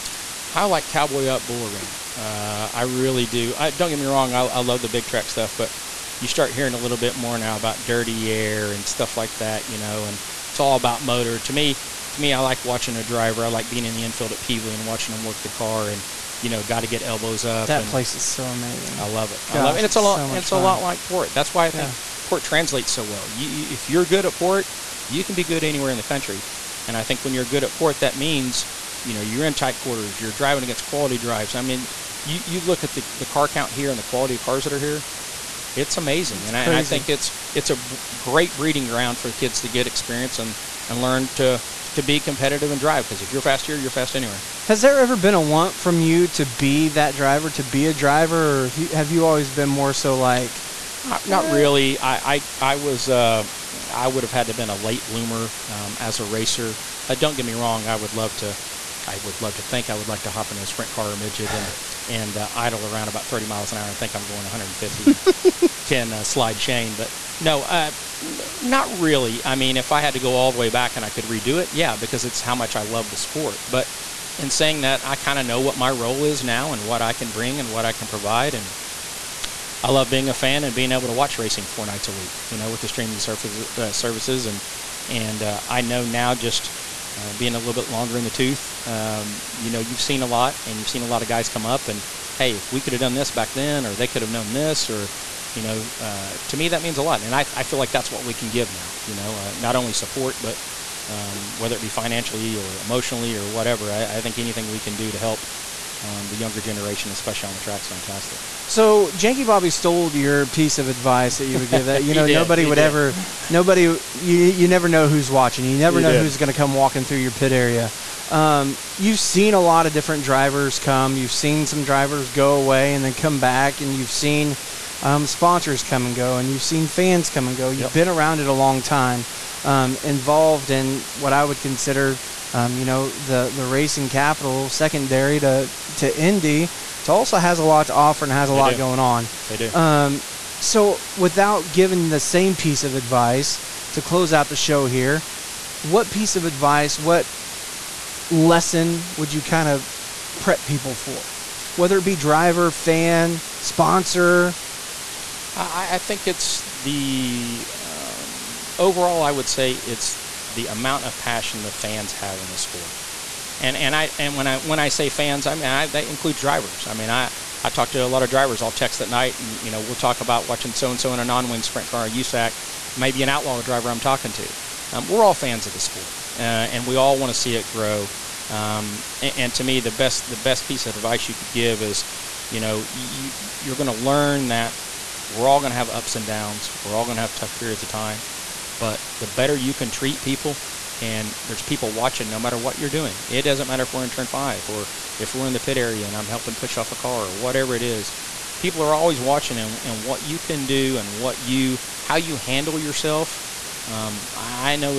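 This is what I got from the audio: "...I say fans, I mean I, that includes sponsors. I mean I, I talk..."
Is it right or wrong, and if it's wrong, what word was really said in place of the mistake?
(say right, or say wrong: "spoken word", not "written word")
wrong: "drivers", not "sponsors".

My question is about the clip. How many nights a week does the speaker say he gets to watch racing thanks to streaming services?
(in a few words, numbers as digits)
4.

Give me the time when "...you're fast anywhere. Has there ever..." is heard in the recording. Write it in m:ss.
0:43.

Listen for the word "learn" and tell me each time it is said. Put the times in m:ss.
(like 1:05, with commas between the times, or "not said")
0:40, 3:03.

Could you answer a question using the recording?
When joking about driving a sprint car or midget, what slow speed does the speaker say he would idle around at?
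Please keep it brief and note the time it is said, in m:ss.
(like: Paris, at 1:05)
30 miles an hour, at 1:03.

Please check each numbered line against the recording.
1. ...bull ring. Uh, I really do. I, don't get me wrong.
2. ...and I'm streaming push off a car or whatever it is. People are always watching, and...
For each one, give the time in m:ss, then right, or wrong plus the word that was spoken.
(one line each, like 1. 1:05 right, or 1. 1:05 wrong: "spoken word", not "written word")
1. 0:01 right
2. 3:16 wrong: "helping", not "streaming".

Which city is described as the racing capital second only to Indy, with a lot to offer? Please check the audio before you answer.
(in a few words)
Tulsa.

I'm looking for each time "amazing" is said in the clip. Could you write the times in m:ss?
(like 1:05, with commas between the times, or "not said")
0:18, 0:35.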